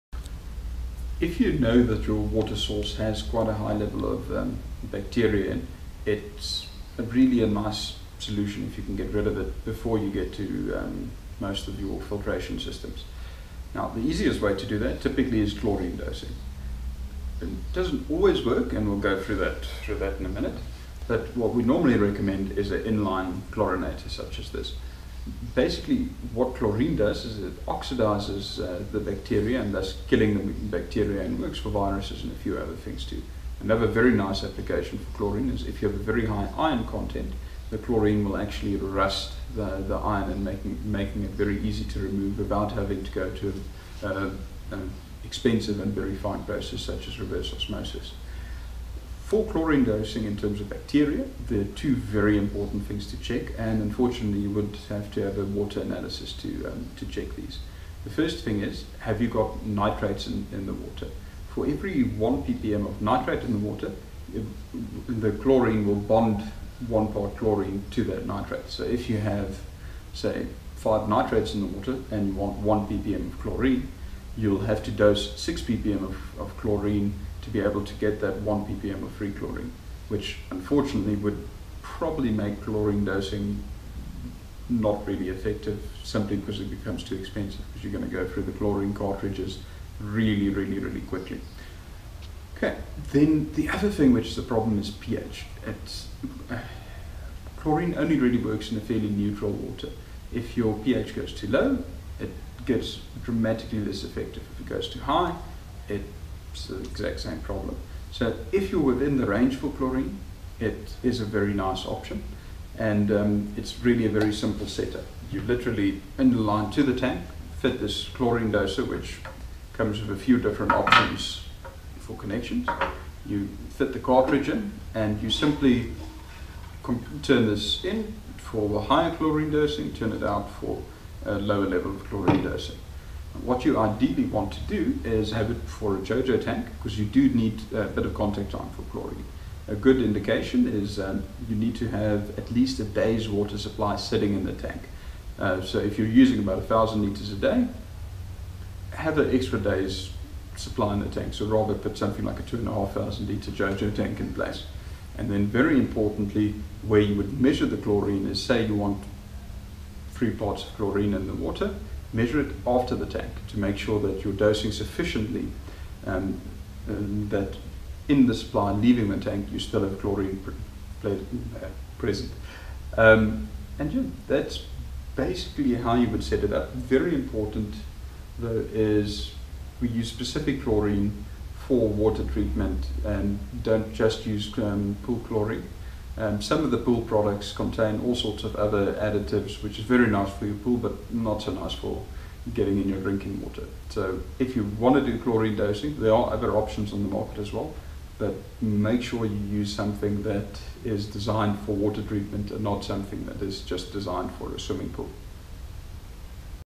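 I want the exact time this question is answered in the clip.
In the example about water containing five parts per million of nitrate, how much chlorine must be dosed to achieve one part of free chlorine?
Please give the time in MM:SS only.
01:15.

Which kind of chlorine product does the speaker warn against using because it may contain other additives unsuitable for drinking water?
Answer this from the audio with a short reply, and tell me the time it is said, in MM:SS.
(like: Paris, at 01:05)
Pool chlorine, at 03:05.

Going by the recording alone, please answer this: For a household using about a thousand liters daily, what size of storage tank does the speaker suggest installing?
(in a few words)
2500 liters.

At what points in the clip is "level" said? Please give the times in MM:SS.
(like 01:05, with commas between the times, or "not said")
00:03, 02:11.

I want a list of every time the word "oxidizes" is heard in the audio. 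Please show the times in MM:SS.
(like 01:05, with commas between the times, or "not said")
00:27.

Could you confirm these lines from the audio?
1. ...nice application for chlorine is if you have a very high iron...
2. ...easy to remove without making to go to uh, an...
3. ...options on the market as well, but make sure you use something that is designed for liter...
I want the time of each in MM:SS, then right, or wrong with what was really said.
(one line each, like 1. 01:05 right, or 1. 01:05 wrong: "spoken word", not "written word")
1. 00:34 right
2. 00:41 wrong: "having", not "making"
3. 03:16 wrong: "water", not "liter".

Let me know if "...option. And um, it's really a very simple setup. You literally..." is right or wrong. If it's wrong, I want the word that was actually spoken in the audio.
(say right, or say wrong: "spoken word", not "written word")
right.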